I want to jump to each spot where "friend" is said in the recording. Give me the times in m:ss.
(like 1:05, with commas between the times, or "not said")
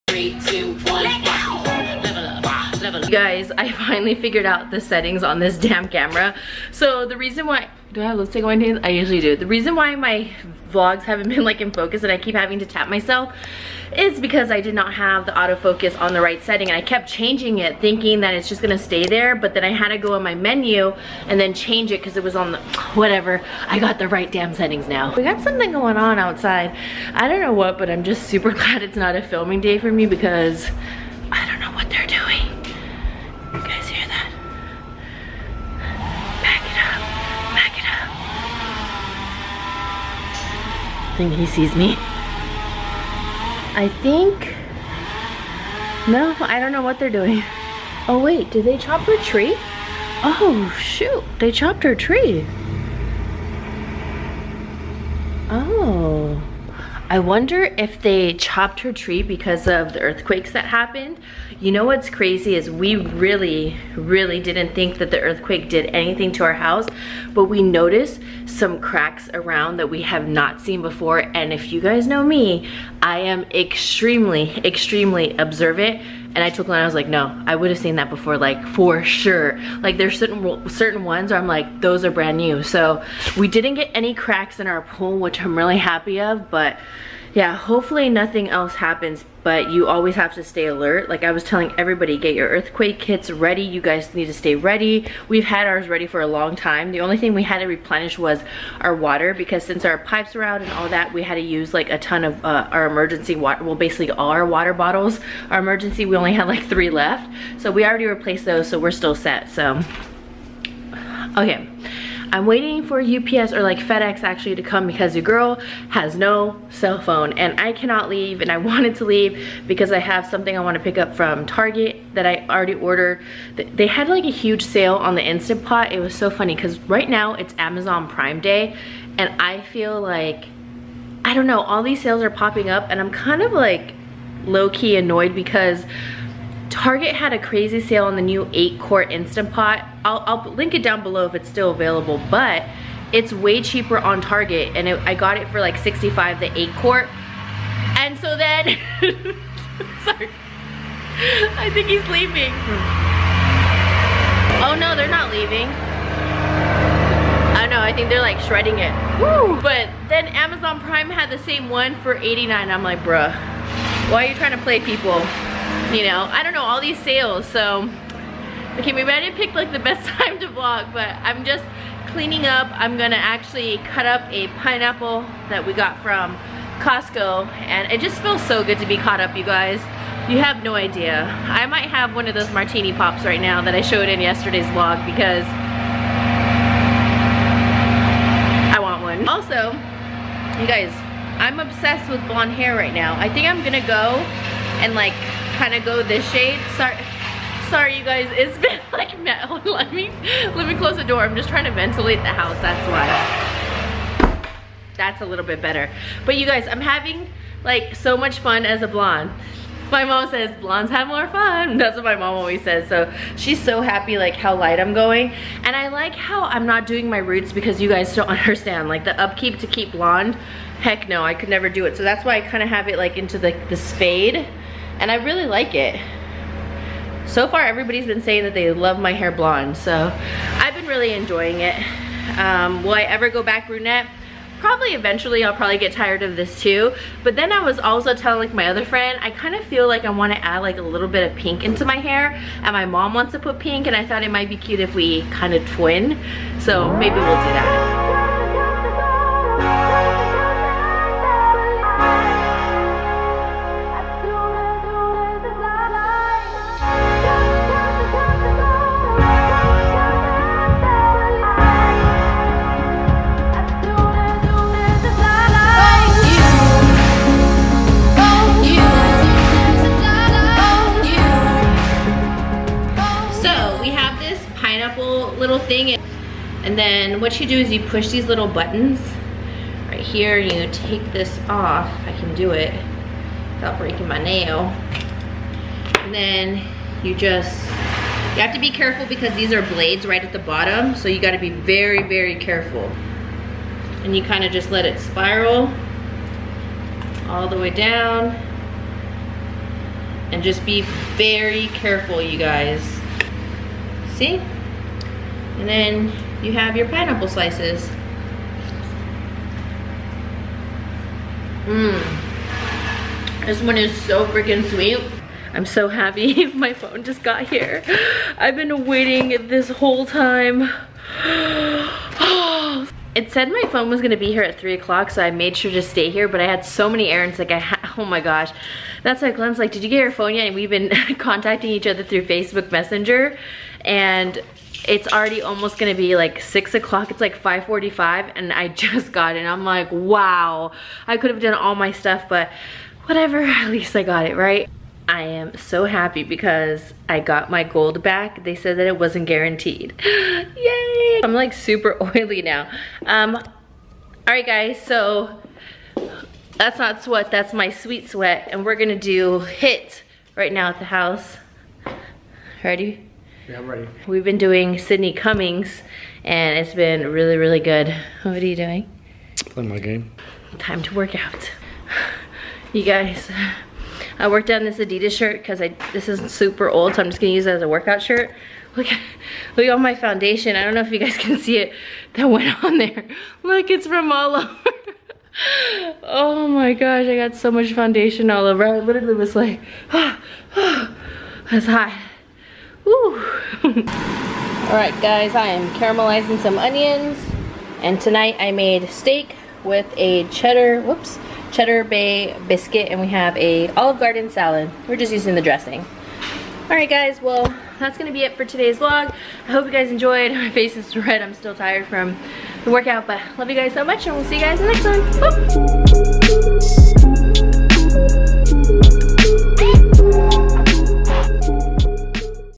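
3:58.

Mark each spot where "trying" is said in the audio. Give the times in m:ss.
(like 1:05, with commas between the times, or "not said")
2:44, 3:21.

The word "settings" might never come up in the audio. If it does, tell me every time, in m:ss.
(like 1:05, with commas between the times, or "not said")
0:04, 0:16, 0:24.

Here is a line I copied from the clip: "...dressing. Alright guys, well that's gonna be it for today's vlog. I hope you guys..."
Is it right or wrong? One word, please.
right.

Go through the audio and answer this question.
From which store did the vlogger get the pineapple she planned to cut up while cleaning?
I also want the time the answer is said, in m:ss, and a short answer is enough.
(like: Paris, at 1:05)
Costco, at 2:56.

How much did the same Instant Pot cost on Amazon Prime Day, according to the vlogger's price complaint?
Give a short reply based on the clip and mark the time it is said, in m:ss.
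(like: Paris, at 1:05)
89, at 2:42.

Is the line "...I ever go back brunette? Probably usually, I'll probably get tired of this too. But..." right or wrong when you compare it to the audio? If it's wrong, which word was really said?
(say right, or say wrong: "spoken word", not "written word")
wrong: "eventually", not "usually".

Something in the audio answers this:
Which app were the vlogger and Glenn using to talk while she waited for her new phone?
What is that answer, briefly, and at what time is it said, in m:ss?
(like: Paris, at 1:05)
Facebook Messenger, at 5:32.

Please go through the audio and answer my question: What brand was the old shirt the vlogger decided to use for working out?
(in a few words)
Adidas.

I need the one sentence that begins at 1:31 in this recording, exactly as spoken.
Like I was telling everybody, get your earthquake kits ready.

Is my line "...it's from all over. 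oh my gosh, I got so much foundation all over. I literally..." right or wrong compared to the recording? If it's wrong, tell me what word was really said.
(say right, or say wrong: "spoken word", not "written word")
right.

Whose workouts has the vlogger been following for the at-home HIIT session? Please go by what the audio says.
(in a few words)
Sydney Cummings.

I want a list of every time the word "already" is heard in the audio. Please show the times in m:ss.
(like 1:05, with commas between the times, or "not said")
1:47, 2:02, 5:35.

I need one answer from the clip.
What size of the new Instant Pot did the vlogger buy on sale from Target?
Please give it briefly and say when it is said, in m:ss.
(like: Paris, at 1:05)
8-quart, at 2:18.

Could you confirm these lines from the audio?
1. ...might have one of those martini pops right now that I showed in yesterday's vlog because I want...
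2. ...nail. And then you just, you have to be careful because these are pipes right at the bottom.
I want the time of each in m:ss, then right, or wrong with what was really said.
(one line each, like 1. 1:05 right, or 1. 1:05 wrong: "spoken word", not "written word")
1. 3:01 right
2. 4:44 wrong: "blades", not "pipes".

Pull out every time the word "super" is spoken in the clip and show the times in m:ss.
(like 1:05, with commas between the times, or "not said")
0:28, 5:51, 6:16.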